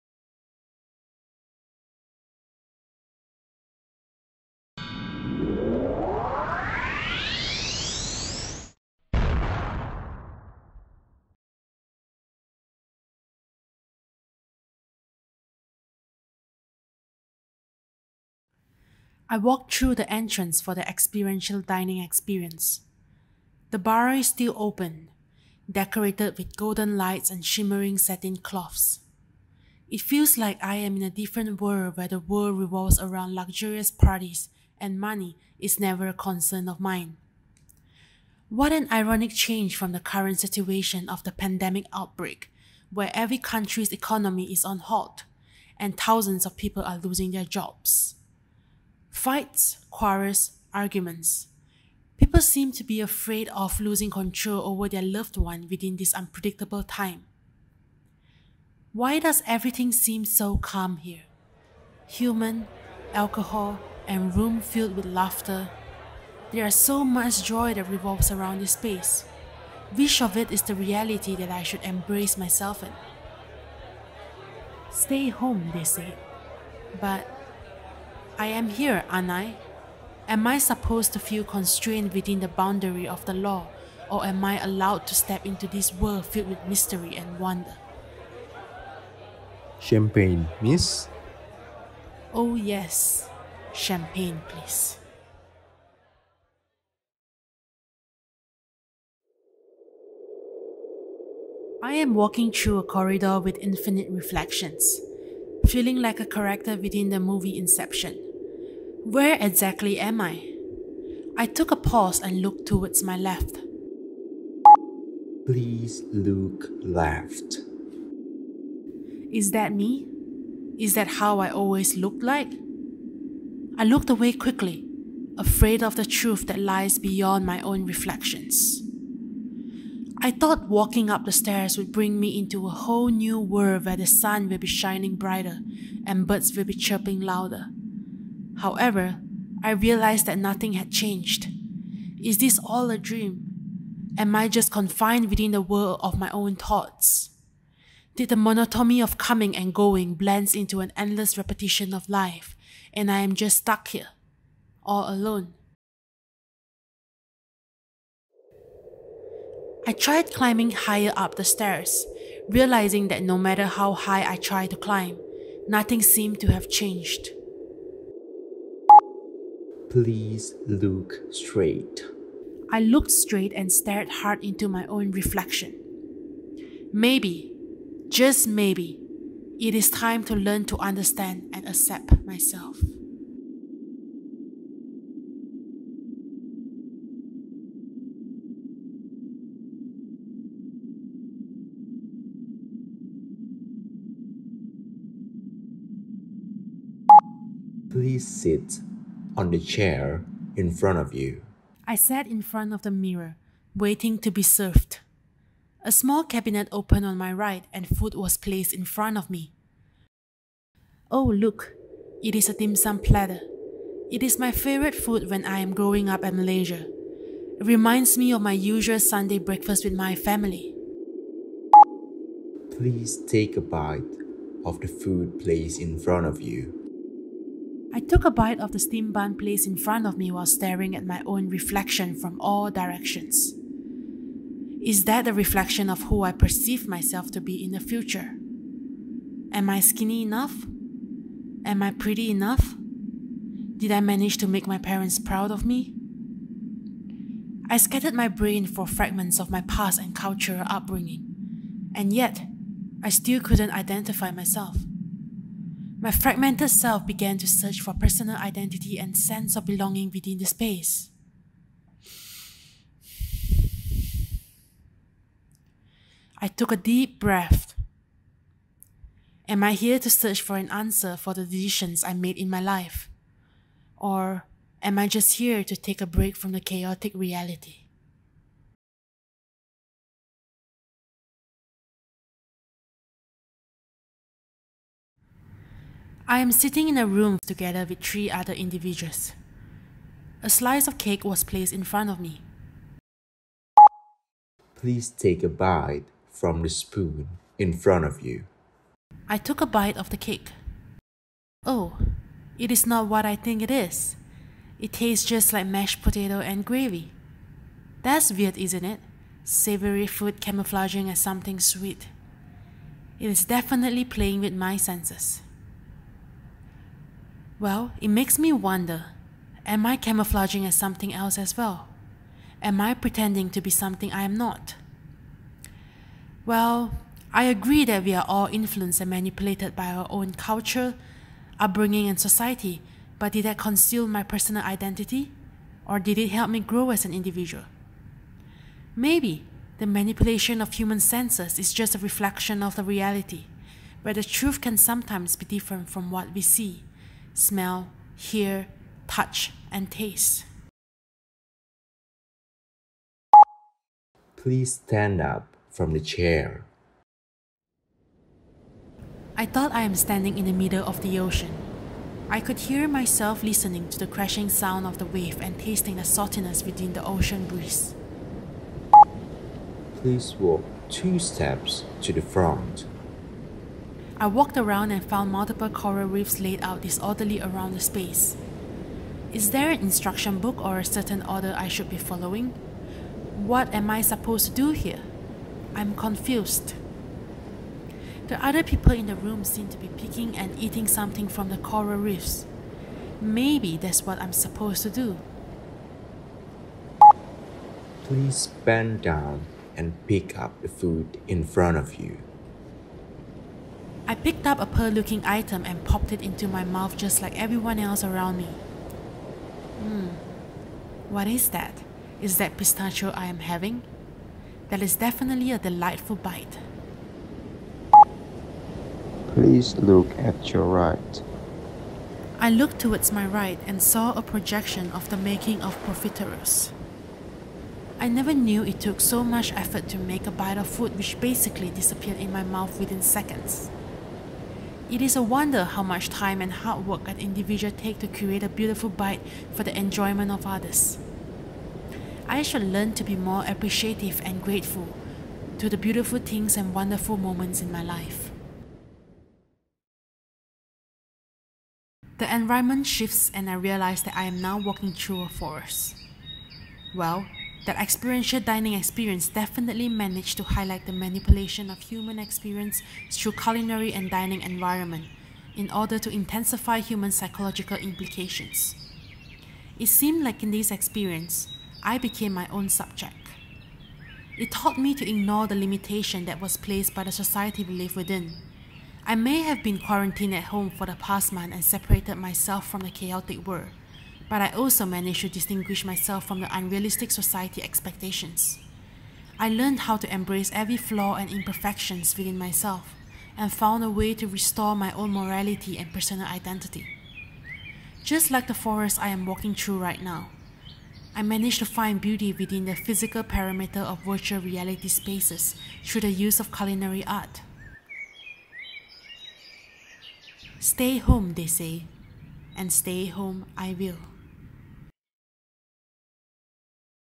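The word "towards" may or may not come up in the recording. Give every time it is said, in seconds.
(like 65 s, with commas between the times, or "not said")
112 s, 422 s.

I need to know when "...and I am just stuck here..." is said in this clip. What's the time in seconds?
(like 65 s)
152 s.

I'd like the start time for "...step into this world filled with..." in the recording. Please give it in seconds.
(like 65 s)
85 s.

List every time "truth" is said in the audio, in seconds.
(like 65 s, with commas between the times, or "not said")
126 s, 344 s.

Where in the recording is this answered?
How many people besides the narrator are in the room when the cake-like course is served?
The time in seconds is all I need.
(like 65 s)
287 s.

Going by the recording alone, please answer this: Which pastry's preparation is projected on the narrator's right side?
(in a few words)
Profiteroles.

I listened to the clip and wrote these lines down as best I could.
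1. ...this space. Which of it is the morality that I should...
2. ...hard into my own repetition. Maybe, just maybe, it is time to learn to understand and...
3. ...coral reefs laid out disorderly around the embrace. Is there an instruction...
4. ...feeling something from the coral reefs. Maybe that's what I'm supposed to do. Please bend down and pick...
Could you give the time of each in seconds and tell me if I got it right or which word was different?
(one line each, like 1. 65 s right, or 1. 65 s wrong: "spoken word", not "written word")
1. 68 s wrong: "reality", not "morality"
2. 174 s wrong: "reflection", not "repetition"
3. 375 s wrong: "space", not "embrace"
4. 390 s wrong: "eating", not "feeling".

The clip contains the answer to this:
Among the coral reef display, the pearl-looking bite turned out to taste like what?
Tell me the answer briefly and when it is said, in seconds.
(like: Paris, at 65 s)
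Pistachio, at 412 s.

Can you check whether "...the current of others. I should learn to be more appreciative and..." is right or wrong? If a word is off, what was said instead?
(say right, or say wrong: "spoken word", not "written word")
wrong: "enjoyment", not "current".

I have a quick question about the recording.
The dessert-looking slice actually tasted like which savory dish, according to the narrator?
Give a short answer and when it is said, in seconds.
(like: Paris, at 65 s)
Mashed potato and gravy, at 305 s.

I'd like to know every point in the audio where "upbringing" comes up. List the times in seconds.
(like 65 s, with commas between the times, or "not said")
250 s, 331 s.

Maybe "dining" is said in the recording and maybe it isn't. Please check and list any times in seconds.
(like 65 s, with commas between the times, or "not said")
21 s, 458 s, 464 s.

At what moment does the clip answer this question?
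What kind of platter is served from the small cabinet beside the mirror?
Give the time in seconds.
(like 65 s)
212 s.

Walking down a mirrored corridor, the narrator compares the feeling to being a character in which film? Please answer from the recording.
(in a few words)
Inception.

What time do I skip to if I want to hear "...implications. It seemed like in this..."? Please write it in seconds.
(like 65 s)
467 s.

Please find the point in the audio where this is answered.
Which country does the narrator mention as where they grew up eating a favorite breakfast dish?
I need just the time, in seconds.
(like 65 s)
216 s.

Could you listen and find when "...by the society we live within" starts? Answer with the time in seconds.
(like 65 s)
476 s.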